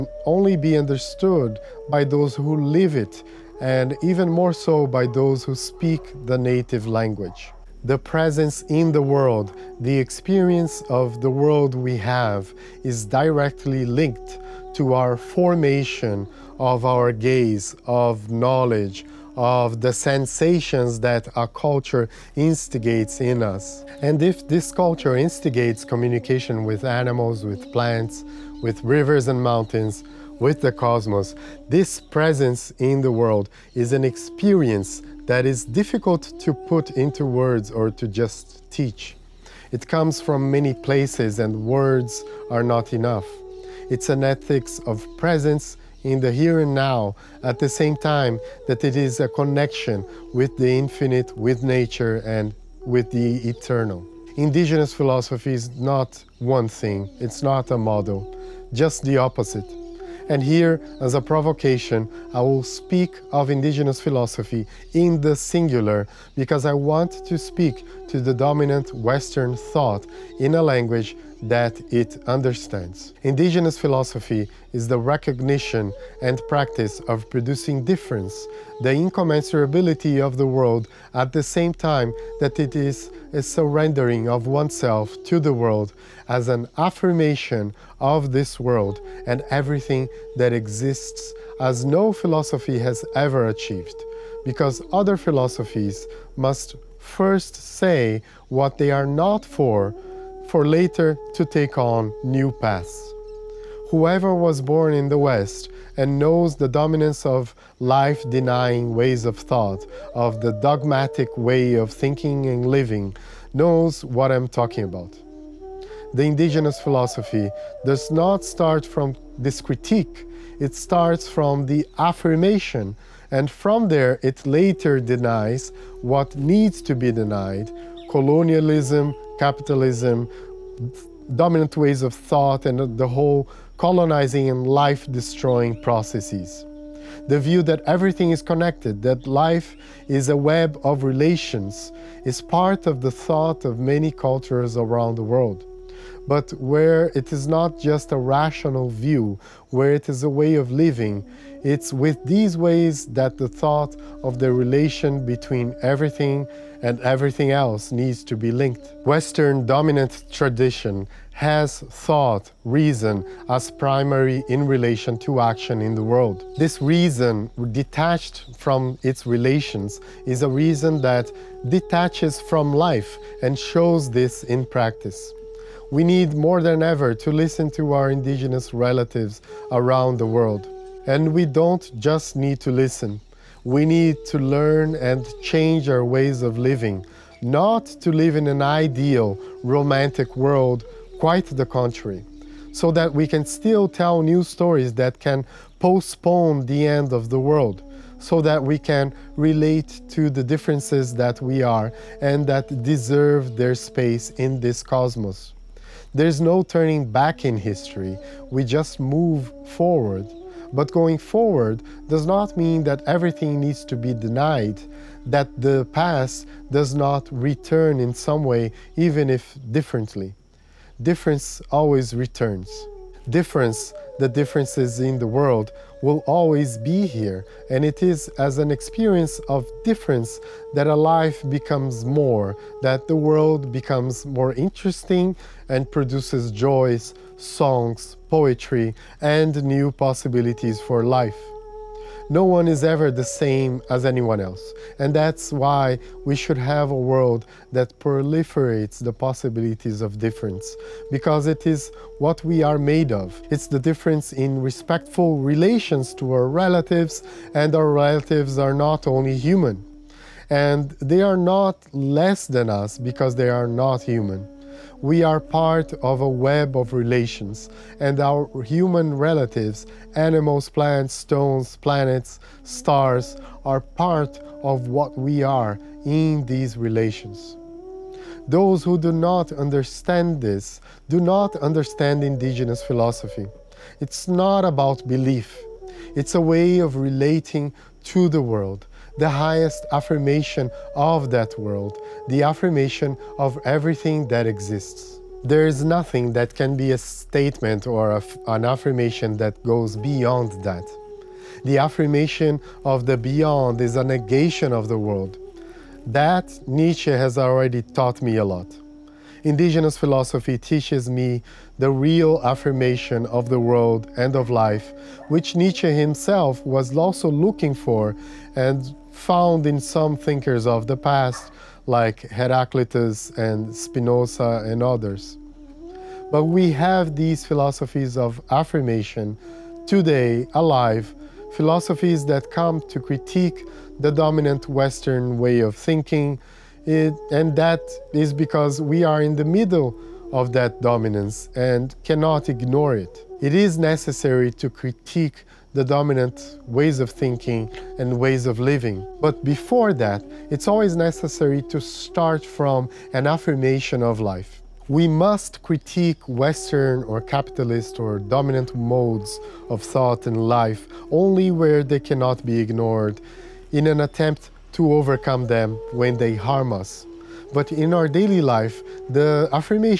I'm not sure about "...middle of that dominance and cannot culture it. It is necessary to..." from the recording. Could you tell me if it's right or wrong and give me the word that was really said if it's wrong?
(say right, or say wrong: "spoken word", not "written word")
wrong: "ignore", not "culture".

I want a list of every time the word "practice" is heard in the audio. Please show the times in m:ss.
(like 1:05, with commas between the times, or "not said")
1:16, 2:54.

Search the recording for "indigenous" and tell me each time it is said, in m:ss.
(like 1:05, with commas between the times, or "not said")
0:54, 1:03, 1:13, 1:56, 2:58, 4:42, 5:09.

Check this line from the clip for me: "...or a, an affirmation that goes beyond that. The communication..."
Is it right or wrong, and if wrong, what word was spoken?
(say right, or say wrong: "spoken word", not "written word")
wrong: "affirmation", not "communication".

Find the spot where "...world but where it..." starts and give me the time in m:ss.
2:25.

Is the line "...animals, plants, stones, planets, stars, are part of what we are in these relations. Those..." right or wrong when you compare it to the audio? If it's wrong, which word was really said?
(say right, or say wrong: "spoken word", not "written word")
right.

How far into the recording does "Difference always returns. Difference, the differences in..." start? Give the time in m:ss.
3:41.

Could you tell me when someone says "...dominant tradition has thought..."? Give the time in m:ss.
2:39.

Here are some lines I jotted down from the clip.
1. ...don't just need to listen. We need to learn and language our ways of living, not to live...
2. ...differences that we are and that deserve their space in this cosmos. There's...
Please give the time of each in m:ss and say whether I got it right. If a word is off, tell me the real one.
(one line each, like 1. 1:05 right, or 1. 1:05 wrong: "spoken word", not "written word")
1. 3:01 wrong: "change", not "language"
2. 3:20 right.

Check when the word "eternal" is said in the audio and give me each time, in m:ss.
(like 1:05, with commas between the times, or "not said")
0:53.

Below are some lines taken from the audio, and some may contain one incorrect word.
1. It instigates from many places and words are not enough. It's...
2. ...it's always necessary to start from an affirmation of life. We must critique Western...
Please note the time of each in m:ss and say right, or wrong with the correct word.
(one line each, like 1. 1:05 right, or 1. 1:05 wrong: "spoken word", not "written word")
1. 0:39 wrong: "comes", not "instigates"
2. 5:50 right.